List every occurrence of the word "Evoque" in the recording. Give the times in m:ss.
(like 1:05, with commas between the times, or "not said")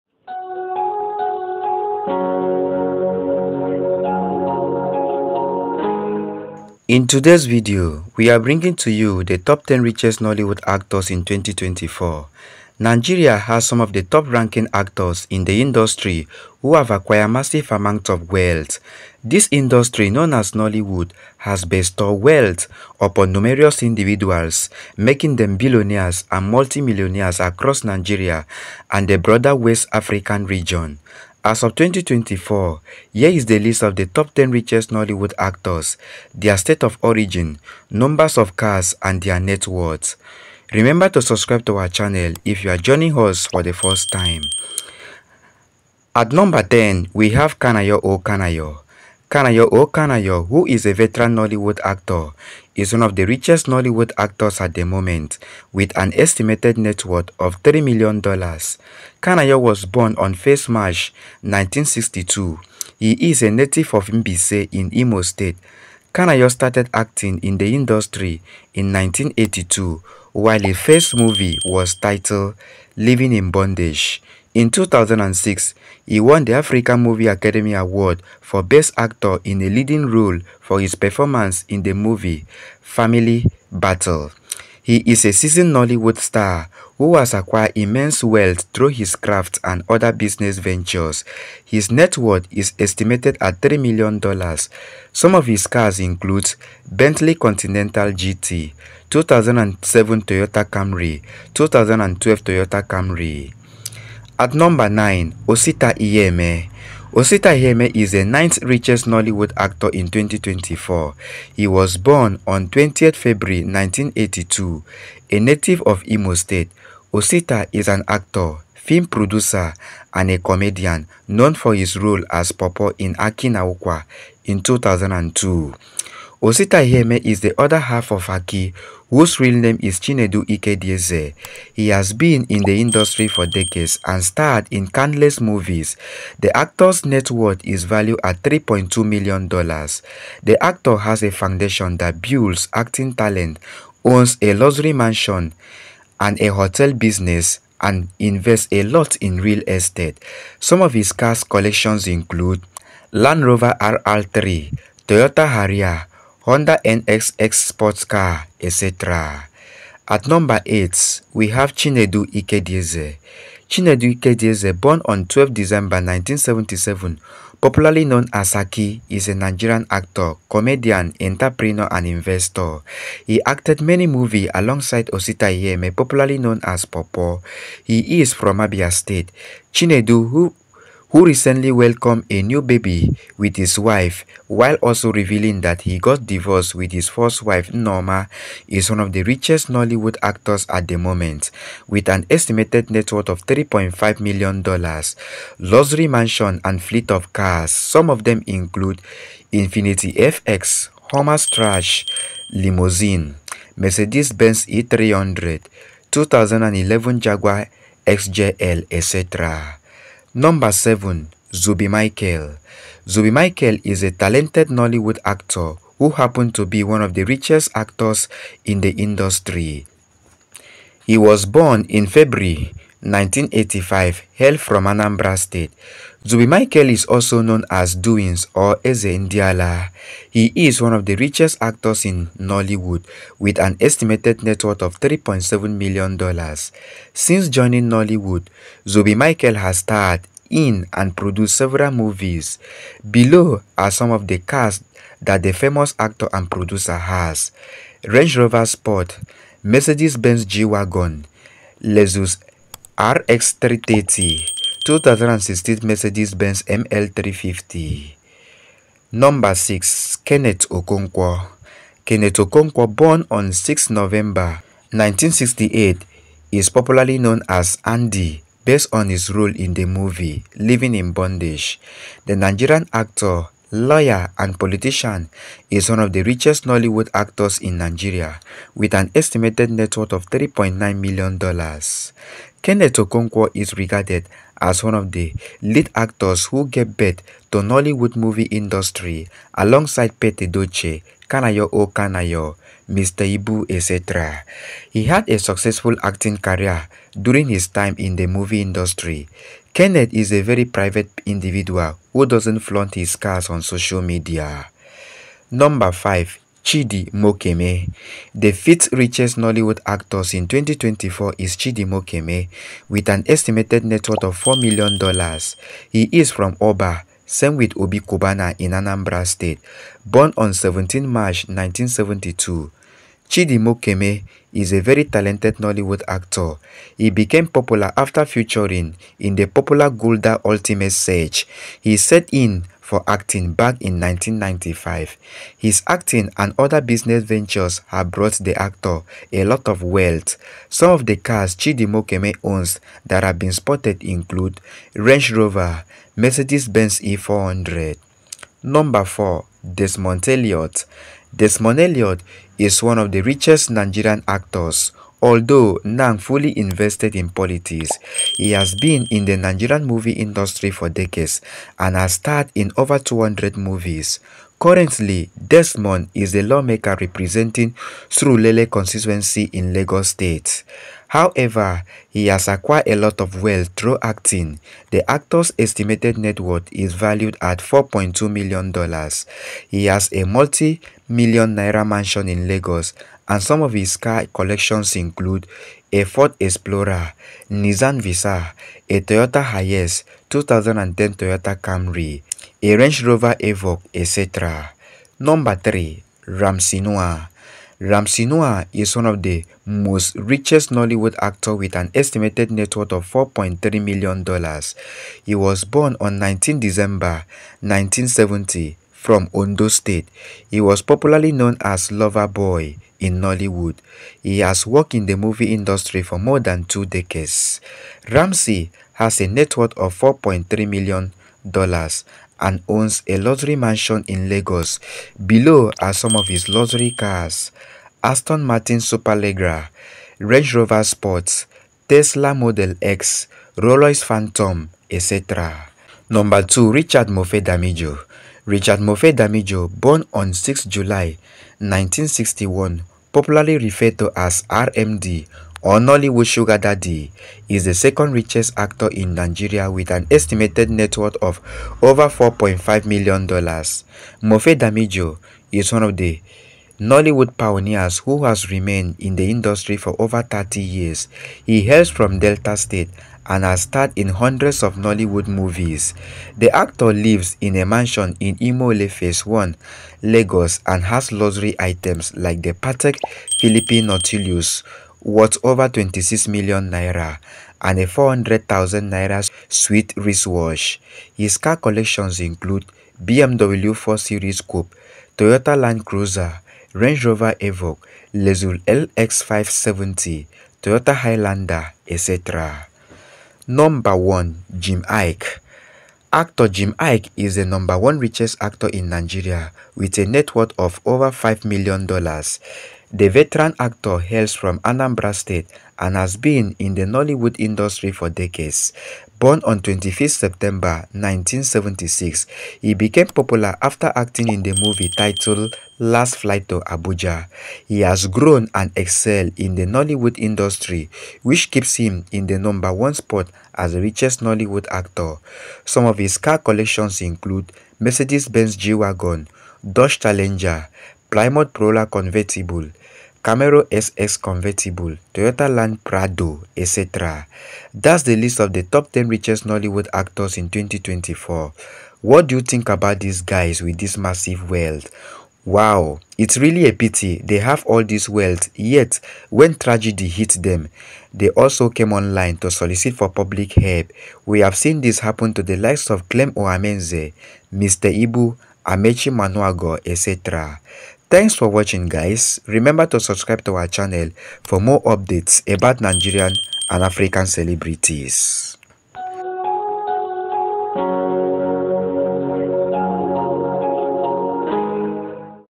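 6:33, 8:07.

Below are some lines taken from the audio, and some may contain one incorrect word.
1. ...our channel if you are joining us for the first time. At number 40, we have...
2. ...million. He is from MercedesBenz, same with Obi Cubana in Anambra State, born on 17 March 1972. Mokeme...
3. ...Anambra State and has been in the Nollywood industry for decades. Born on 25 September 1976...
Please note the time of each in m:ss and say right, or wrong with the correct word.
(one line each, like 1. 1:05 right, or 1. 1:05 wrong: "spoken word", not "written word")
1. 0:41 wrong: "10", not "40"
2. 5:14 wrong: "Oba", not "MercedesBenz"
3. 8:24 right.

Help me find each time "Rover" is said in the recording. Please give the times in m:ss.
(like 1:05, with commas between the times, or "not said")
2:33, 4:08, 5:45, 6:33, 7:10, 8:07.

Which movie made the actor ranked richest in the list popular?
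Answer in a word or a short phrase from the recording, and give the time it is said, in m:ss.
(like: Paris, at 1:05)
Last Flight to Abuja, at 8:35.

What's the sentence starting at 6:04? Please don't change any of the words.
Currently, Desmond is a lawmaker representing Surulere constituency in Lagos State.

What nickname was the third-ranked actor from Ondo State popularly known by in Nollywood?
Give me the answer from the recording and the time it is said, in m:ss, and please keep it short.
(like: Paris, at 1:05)
Lover Boy, at 6:51.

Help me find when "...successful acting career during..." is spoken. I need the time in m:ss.
4:55.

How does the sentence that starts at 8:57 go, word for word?
That's the list of the top 10 richest Nollywood actors in 2024.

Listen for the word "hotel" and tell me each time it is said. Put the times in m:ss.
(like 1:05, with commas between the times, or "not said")
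2:26.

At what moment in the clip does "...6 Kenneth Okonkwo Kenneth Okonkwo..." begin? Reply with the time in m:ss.
4:19.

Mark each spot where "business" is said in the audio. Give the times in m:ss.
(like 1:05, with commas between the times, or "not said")
1:30, 2:26, 5:36.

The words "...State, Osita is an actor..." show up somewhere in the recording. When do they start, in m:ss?
1:56.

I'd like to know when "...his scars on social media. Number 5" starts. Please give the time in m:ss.
5:02.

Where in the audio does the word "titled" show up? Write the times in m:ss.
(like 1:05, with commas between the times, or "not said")
1:11, 8:34.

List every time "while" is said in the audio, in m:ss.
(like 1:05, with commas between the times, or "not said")
1:10, 3:04.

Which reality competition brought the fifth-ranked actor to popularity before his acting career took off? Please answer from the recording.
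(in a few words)
Gulder Ultimate Search.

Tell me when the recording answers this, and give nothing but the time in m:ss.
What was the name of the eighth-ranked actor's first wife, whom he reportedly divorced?
3:07.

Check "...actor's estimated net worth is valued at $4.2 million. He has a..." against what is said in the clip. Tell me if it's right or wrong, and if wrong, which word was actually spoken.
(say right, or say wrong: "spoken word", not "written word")
right.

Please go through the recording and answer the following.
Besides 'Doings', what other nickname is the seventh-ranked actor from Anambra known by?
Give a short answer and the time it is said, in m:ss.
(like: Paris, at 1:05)
Eze Ndiala, at 3:48.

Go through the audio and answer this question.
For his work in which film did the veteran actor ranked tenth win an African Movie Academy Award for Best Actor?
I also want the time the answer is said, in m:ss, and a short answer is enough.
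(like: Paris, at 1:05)
Family Battle, at 1:22.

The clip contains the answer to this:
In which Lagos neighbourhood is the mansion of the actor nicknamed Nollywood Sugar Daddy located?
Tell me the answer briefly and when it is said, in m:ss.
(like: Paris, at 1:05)
Omole Phase 1, at 7:48.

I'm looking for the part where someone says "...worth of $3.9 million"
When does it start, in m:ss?
4:39.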